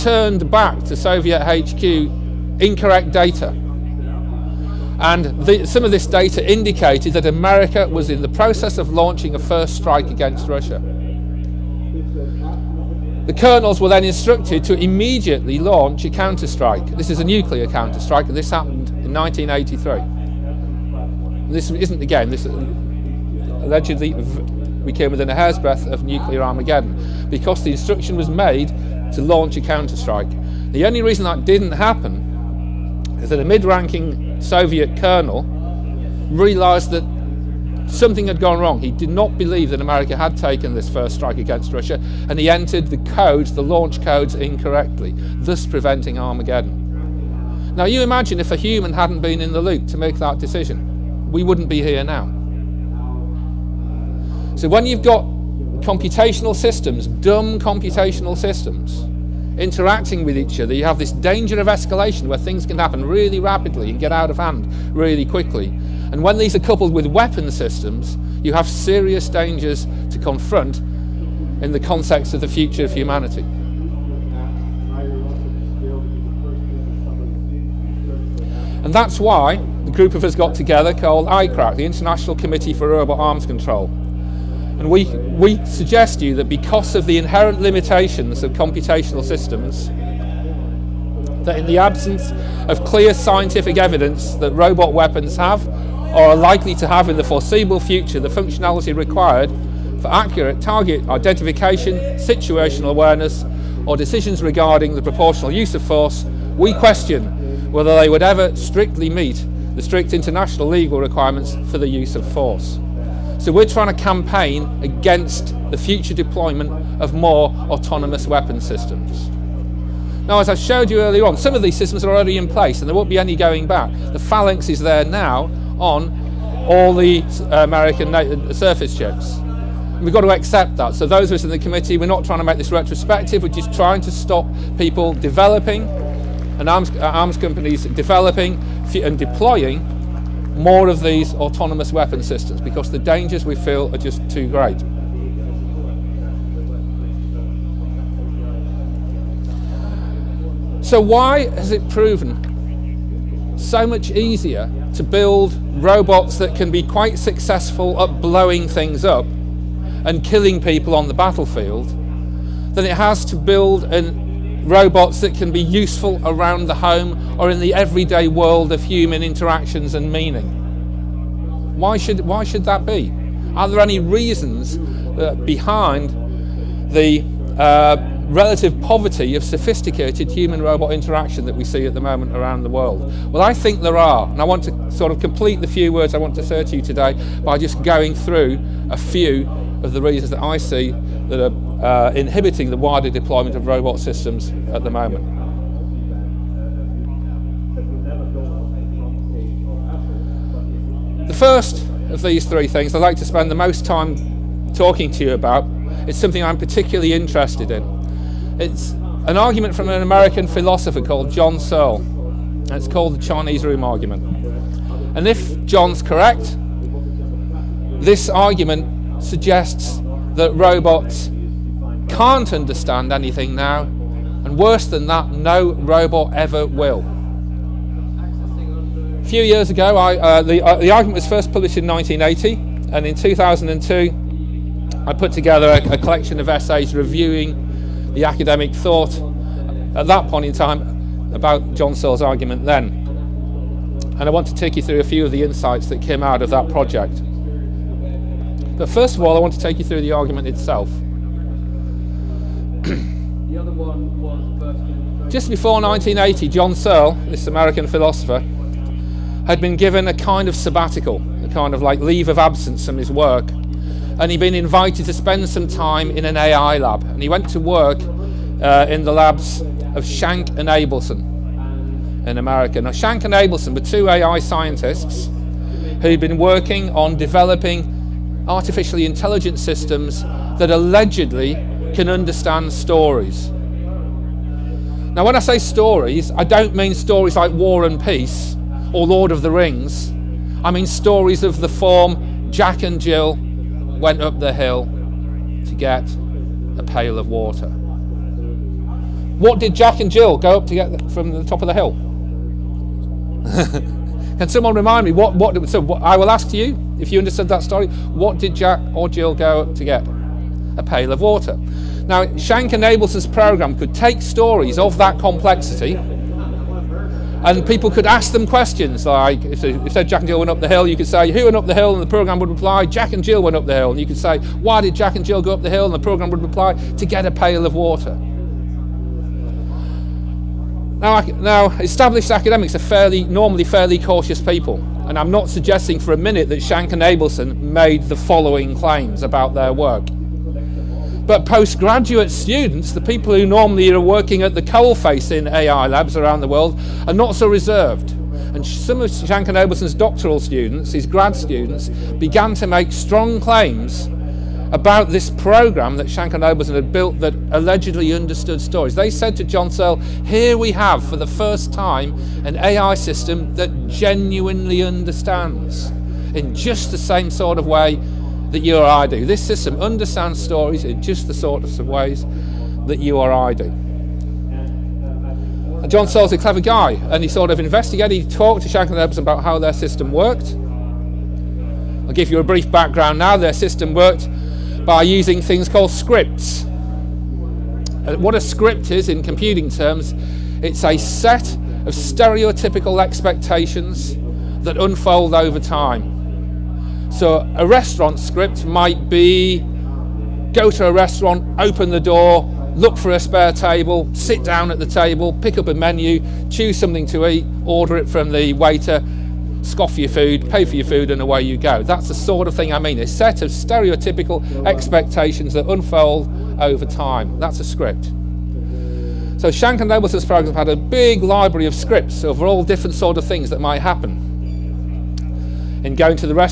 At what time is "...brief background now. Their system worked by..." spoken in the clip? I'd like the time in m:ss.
6:22.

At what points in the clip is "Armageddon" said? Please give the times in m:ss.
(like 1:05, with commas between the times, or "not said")
0:26, 0:46.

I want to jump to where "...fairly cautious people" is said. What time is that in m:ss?
5:33.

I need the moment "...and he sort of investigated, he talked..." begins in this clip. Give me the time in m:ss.
6:16.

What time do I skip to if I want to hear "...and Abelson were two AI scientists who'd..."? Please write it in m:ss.
4:33.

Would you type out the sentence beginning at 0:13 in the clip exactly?
The colonels were then instructed to immediately launch a counterstrike.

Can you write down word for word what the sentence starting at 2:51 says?
Why should, why should that be?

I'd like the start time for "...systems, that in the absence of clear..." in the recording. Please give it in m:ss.
1:29.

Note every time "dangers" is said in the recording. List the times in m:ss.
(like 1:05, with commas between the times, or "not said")
1:01, 1:09, 2:22.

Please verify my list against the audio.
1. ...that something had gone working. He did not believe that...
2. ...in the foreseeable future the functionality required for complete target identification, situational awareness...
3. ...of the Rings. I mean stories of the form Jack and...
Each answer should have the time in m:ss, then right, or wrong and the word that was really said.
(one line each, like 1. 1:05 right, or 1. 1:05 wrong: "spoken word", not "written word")
1. 0:36 wrong: "wrong", not "working"
2. 1:37 wrong: "accurate", not "complete"
3. 4:49 right.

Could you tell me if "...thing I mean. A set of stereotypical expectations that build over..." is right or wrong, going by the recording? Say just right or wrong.
wrong.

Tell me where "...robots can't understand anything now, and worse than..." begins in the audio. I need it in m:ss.
3:40.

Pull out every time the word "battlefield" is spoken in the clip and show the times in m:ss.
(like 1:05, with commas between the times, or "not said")
2:41.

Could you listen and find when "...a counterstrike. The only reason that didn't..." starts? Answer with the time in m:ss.
0:29.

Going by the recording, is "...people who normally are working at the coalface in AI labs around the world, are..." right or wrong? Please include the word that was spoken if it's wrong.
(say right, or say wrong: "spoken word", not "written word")
right.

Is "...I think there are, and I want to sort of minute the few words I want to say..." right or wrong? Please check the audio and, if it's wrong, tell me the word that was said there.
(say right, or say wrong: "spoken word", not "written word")
wrong: "complete", not "minute".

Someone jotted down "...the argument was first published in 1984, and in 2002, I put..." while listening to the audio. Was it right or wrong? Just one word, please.
wrong.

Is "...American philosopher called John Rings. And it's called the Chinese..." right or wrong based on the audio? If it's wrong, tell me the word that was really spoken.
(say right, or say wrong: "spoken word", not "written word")
wrong: "Searle", not "Rings".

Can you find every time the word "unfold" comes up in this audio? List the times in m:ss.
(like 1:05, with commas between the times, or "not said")
6:34, 6:55.